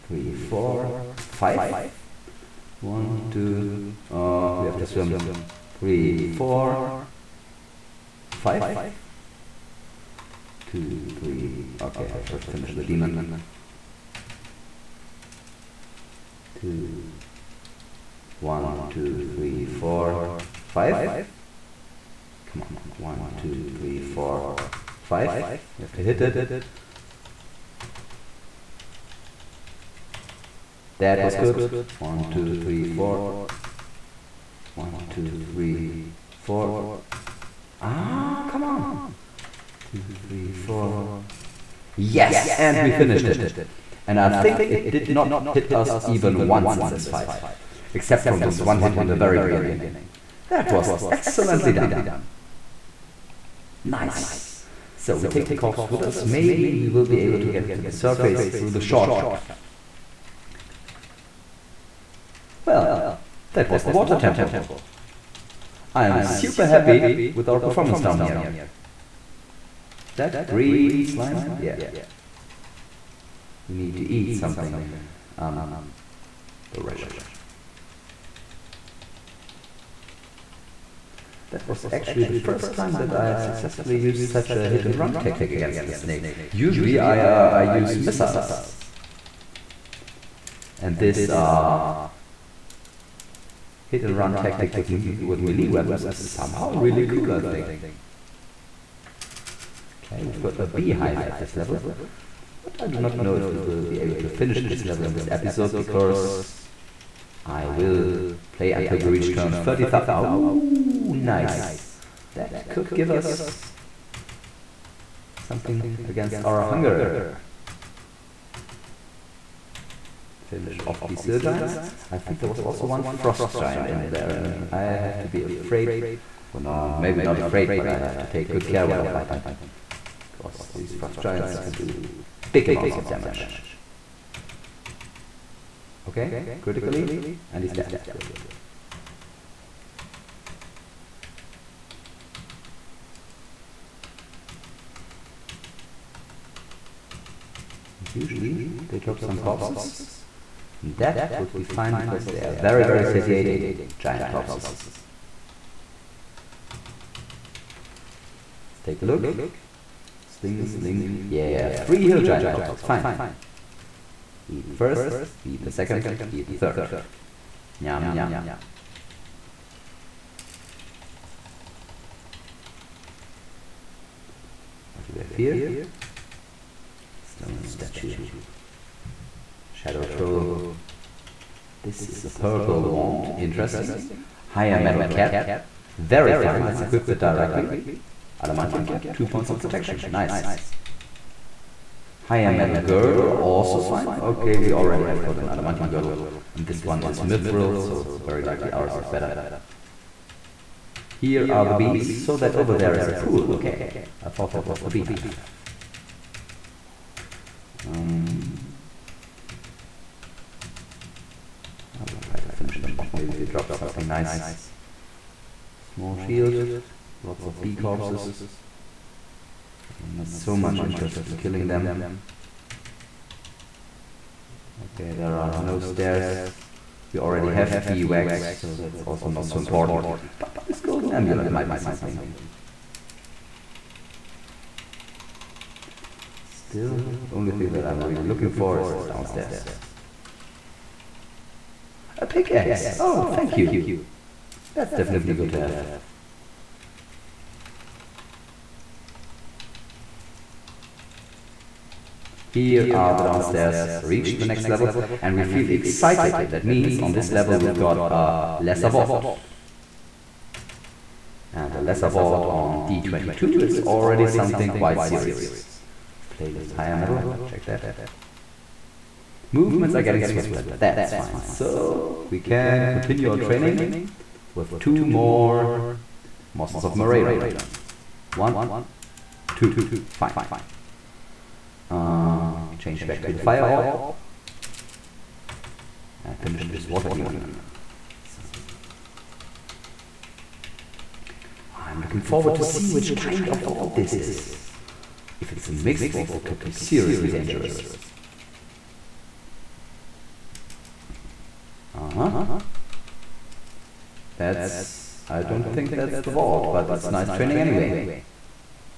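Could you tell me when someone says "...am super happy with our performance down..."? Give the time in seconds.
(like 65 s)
66 s.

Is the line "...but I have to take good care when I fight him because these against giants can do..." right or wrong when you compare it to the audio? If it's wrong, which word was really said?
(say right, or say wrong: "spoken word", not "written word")
wrong: "frost", not "against".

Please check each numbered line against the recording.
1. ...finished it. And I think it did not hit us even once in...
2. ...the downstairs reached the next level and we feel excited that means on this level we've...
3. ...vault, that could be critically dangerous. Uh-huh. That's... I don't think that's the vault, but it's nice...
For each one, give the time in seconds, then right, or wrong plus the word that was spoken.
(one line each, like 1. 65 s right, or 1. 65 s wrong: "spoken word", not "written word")
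1. 42 s right
2. 253 s right
3. 296 s wrong: "seriously", not "critically".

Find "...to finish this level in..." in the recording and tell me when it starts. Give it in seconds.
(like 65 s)
104 s.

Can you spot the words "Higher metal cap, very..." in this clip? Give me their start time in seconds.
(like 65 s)
184 s.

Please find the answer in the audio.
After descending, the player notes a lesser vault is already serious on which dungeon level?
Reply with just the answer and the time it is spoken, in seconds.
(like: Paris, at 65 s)
D22, at 262 s.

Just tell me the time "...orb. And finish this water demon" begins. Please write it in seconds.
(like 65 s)
283 s.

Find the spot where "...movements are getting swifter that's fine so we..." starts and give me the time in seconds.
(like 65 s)
269 s.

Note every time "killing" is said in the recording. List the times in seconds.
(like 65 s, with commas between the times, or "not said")
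221 s.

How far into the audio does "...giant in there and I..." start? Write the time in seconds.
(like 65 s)
123 s.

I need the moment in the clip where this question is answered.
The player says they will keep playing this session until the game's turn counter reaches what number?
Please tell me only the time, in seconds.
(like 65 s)
109 s.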